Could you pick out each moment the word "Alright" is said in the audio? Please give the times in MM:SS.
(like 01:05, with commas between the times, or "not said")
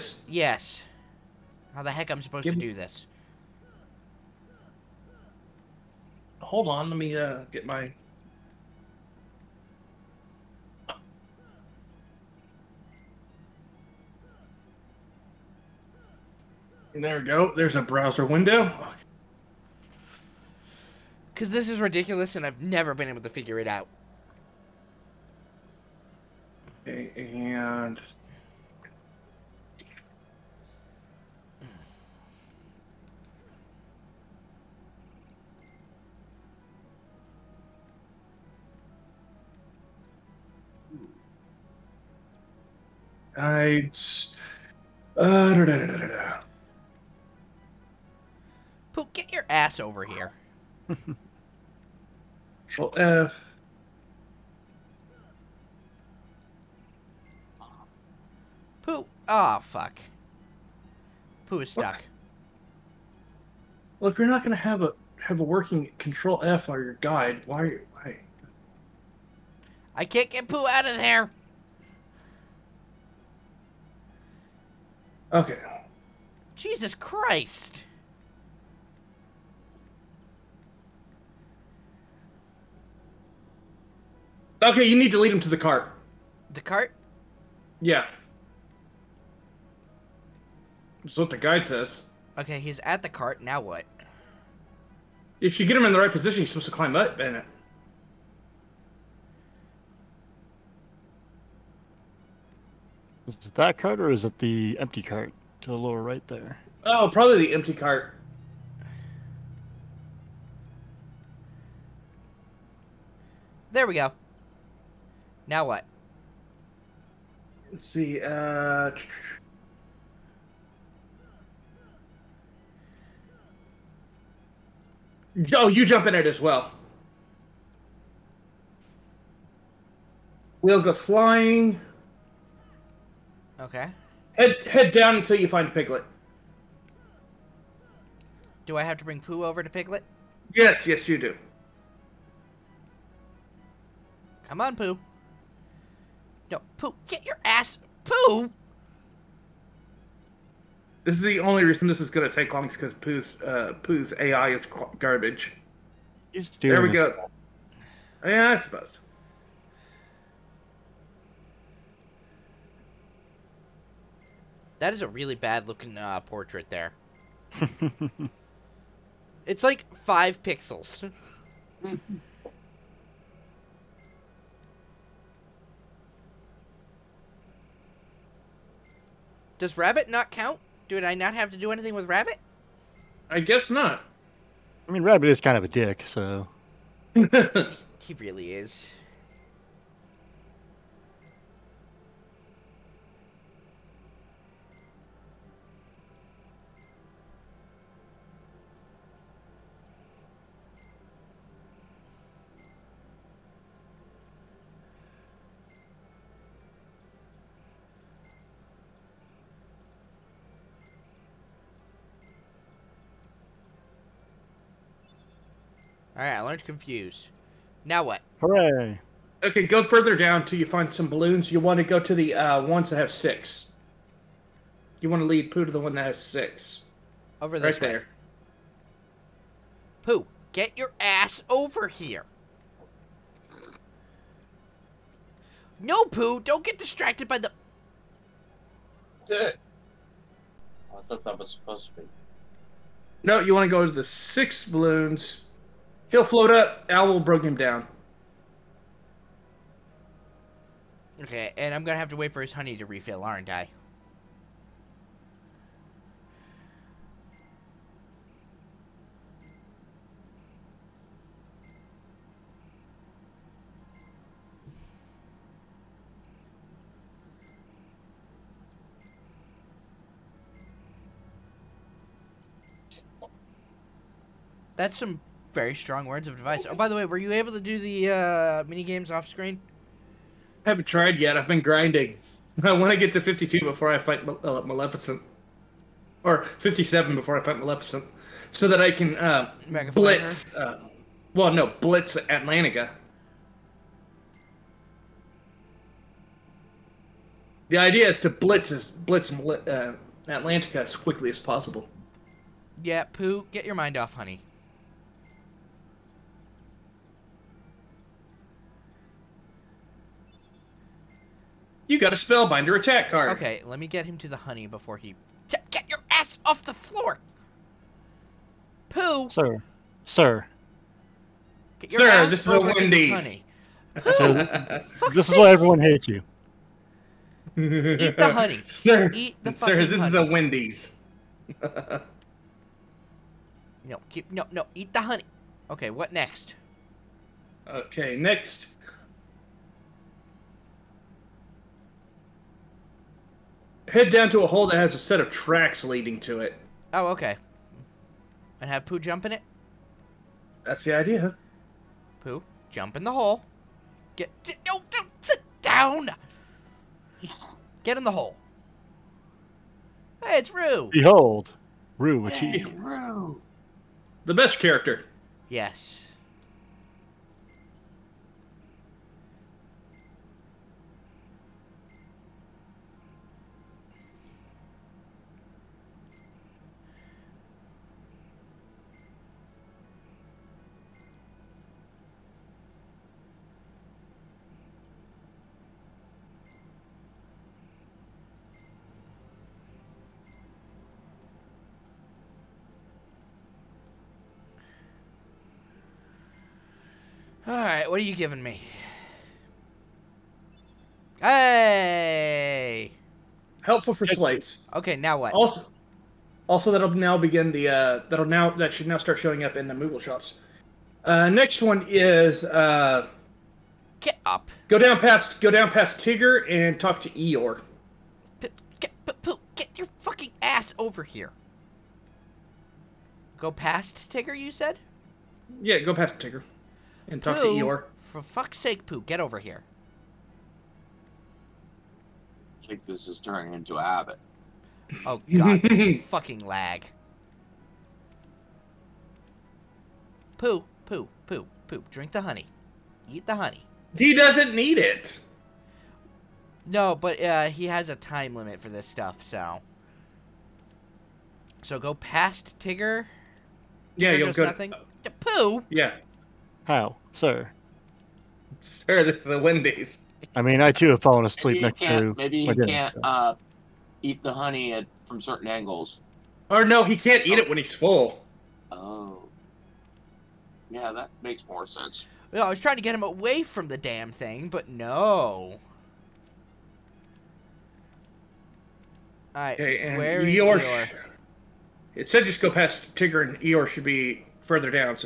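03:36, 06:37, 07:59.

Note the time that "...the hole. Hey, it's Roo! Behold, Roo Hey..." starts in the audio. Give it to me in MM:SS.
05:58.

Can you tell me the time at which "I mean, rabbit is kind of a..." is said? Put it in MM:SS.
03:04.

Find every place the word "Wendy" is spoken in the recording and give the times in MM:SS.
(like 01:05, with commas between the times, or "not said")
05:22, 05:30, 07:39.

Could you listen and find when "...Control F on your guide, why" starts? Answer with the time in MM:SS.
01:05.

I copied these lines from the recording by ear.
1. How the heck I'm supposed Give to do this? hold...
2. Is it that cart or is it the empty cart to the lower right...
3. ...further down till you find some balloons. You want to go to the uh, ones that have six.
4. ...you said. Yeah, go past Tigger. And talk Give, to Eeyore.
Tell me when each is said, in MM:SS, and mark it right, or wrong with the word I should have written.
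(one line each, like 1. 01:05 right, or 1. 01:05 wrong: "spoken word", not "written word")
1. 00:01 right
2. 01:43 right
3. 03:39 right
4. 07:04 wrong: "Pooh", not "Give".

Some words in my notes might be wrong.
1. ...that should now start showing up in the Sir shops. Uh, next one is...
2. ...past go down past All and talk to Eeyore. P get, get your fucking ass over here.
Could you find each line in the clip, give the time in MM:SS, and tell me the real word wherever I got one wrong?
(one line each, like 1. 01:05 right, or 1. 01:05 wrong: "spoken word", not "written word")
1. 06:48 wrong: "Moogle", not "Sir"
2. 06:54 wrong: "Tigger", not "All".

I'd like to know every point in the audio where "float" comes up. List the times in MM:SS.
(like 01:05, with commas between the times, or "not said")
04:06.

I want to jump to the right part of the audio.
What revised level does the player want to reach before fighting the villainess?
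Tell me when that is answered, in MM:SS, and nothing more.
04:46.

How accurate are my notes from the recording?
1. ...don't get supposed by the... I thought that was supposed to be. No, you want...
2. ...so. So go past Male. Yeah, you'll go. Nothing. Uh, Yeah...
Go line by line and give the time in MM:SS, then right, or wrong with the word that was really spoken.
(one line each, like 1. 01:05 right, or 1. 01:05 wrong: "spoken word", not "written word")
1. 03:56 wrong: "distracted", not "supposed"
2. 07:29 wrong: "Tigger", not "Male".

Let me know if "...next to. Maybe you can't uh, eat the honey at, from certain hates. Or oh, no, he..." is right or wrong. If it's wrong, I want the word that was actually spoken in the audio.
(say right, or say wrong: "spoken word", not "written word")
wrong: "angles", not "hates".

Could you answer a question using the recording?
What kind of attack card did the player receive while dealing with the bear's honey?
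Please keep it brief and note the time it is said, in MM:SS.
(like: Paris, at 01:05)
Spellbinder, at 05:12.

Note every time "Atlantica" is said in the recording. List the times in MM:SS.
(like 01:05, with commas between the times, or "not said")
04:52, 05:00.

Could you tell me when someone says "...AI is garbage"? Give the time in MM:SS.
02:34.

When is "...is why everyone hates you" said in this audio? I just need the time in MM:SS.
05:25.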